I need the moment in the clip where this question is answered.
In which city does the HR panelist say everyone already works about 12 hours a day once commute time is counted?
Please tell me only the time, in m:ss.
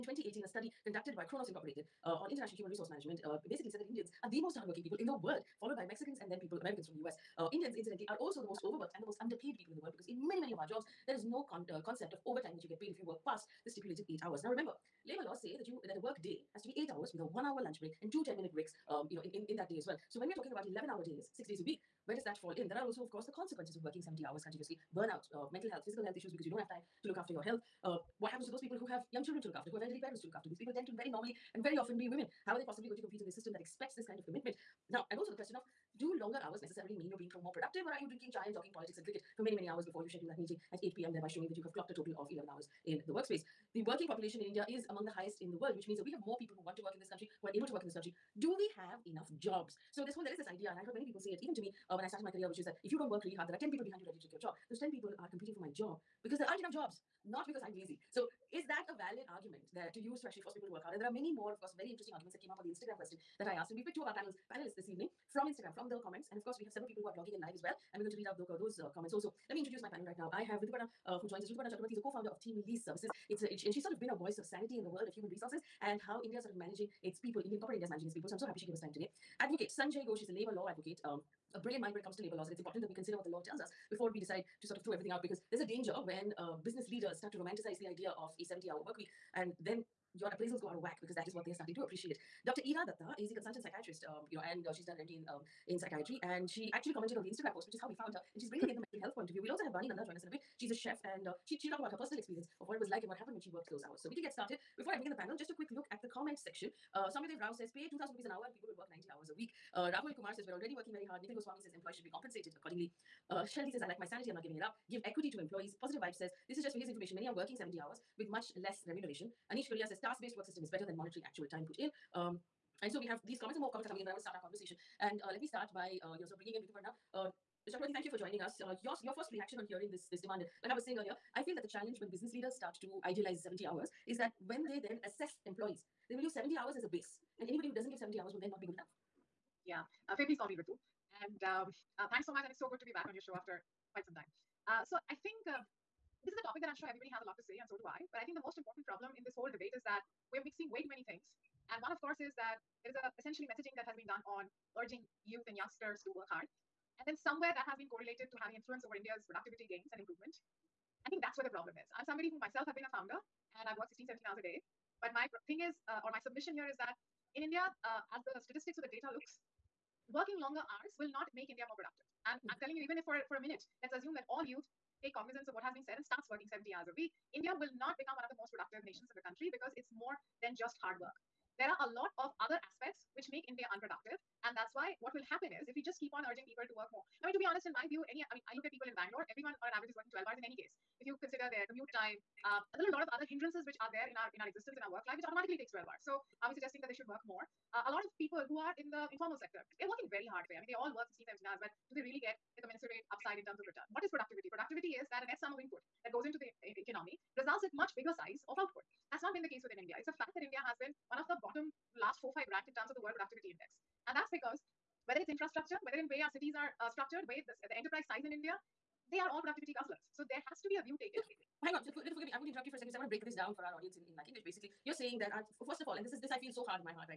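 3:08.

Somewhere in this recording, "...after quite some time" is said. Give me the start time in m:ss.
2:23.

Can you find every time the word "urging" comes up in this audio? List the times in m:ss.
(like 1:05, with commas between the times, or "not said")
2:34, 3:06.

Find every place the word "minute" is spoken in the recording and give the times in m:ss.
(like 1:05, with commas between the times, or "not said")
0:18, 2:53.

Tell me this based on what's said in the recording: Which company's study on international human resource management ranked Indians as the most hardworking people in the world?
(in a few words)
Kronos Incorporated.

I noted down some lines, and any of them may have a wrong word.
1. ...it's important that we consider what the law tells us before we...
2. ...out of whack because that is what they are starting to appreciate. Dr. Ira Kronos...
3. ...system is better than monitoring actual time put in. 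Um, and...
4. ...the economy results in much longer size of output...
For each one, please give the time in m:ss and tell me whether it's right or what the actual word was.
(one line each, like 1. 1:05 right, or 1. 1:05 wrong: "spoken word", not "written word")
1. 1:22 right
2. 1:30 wrong: "Datta", not "Kronos"
3. 2:00 right
4. 3:26 wrong: "bigger", not "longer".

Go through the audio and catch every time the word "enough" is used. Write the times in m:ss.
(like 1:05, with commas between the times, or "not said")
0:49, 0:56, 2:18.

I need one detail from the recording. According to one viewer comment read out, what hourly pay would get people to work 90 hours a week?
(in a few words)
2,000 rupees.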